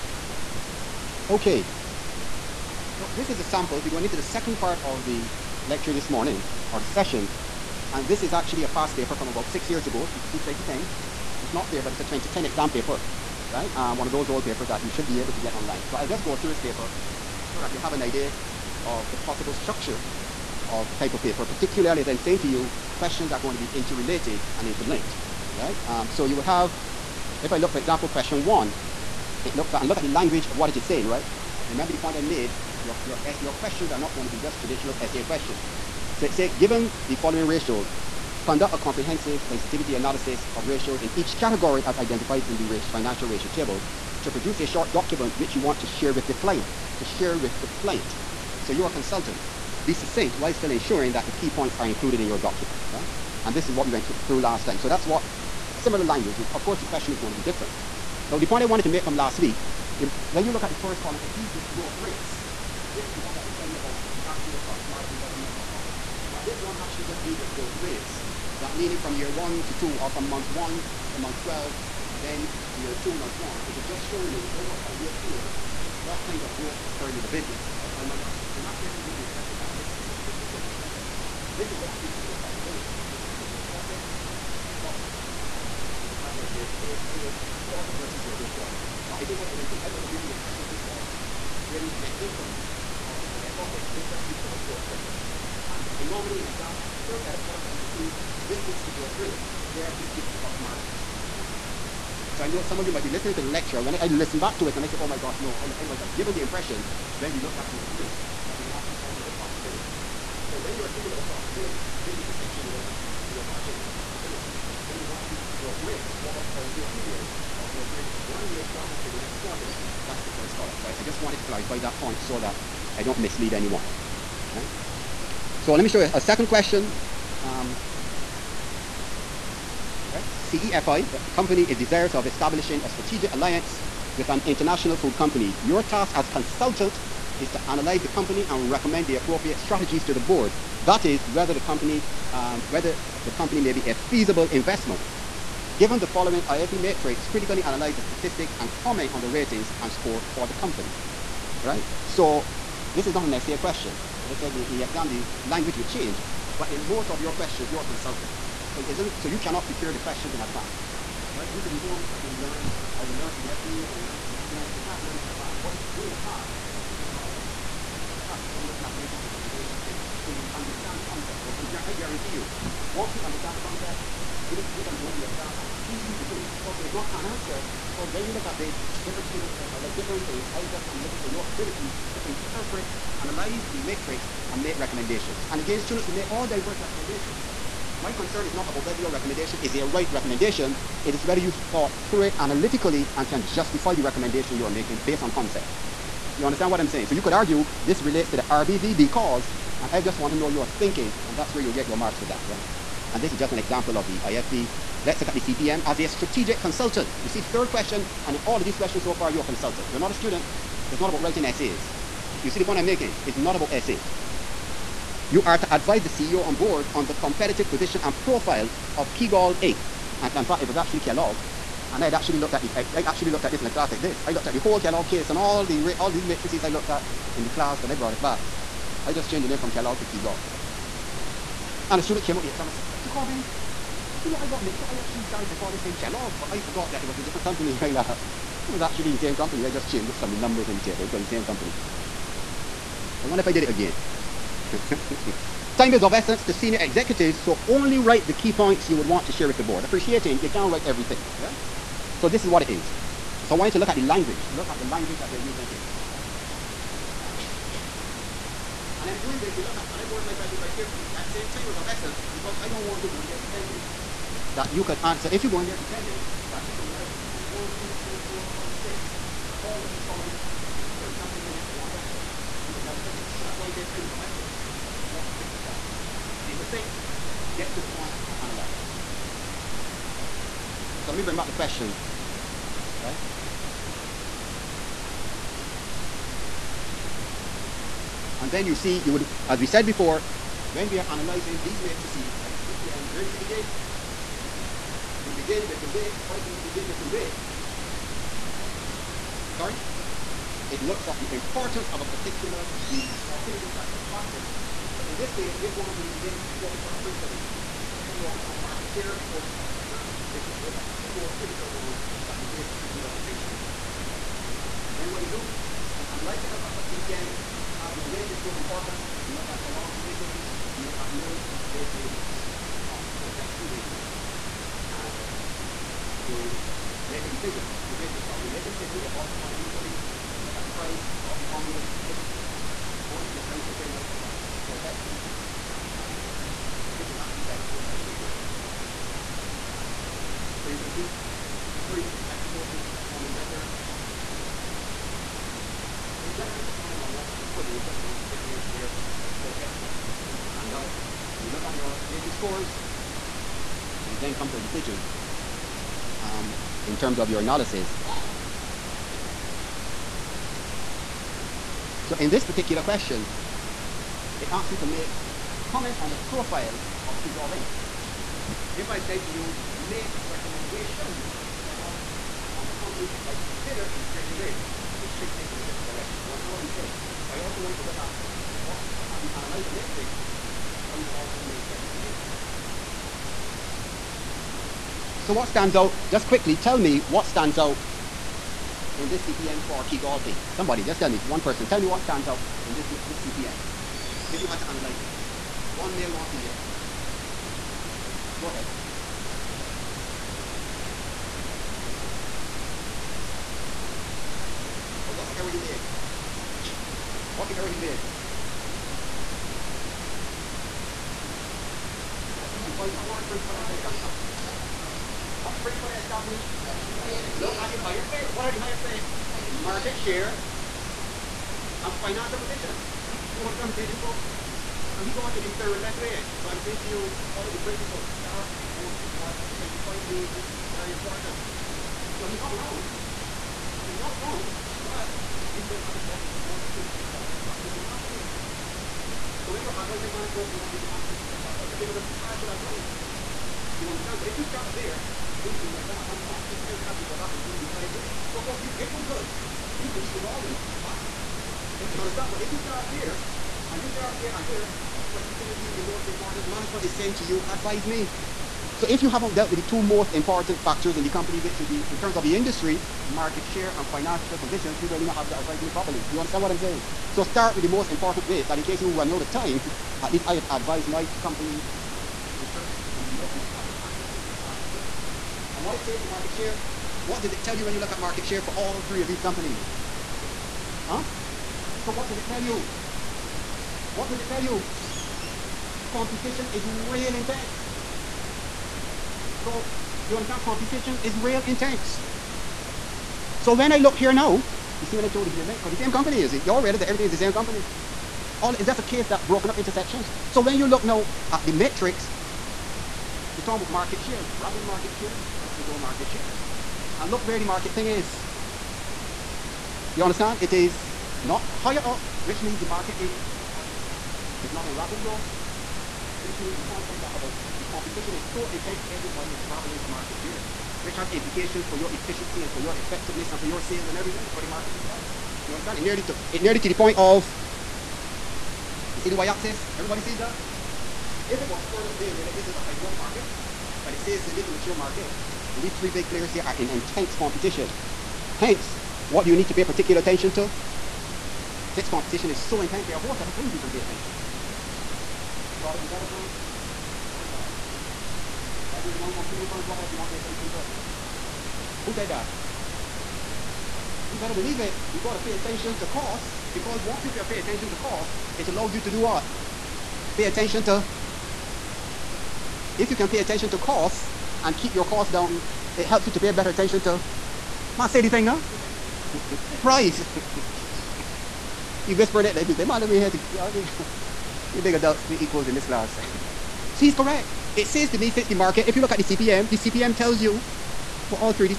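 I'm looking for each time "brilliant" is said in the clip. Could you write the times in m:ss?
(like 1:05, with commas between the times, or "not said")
not said.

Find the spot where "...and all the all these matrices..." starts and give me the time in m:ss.
3:45.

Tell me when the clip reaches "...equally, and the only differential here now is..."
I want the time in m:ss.
5:31.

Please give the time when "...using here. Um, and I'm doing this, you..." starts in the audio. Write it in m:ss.
4:15.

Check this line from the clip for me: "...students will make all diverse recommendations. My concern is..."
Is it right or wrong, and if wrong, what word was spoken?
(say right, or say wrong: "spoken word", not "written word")
right.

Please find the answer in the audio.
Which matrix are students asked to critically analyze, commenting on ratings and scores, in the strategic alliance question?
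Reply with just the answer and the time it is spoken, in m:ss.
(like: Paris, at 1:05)
IFE matrix, at 2:26.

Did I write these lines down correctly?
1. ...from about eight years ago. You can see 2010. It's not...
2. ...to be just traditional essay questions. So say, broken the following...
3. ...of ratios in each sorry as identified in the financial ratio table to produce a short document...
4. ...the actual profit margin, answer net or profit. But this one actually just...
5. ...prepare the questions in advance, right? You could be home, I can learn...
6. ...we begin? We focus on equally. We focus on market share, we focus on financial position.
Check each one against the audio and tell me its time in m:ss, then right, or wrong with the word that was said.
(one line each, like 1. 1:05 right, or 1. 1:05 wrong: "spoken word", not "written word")
1. 0:09 wrong: "six", not "eight"
2. 0:34 wrong: "given", not "broken"
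3. 0:40 wrong: "category", not "sorry"
4. 1:04 wrong: "whether", not "answer"
5. 2:39 right
6. 5:06 wrong: "critically", not "equally".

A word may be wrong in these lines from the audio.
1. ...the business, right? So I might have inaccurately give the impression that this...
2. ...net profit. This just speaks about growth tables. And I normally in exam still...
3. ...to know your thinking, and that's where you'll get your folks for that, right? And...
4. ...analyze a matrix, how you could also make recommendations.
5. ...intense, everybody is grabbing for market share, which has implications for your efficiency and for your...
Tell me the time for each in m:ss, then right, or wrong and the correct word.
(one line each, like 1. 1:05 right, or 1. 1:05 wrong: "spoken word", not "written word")
1. 1:17 right
2. 1:33 wrong: "rates", not "tables"
3. 3:20 wrong: "marks", not "folks"
4. 6:19 right
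5. 8:38 right.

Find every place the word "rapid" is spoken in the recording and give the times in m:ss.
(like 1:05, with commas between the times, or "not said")
8:24, 8:34.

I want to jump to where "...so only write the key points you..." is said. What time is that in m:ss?
4:07.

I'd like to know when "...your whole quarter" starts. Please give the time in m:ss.
1:28.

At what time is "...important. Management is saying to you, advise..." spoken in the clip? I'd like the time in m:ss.
7:36.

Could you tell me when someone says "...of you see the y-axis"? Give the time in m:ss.
8:46.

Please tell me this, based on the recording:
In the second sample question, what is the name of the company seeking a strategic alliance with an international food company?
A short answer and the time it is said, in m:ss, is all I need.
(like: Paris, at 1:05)
CEFI, at 2:10.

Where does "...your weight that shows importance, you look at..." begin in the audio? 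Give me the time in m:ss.
5:17.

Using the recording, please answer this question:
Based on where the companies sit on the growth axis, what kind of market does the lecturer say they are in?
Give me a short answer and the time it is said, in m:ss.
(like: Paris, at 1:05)
A mature market, at 8:54.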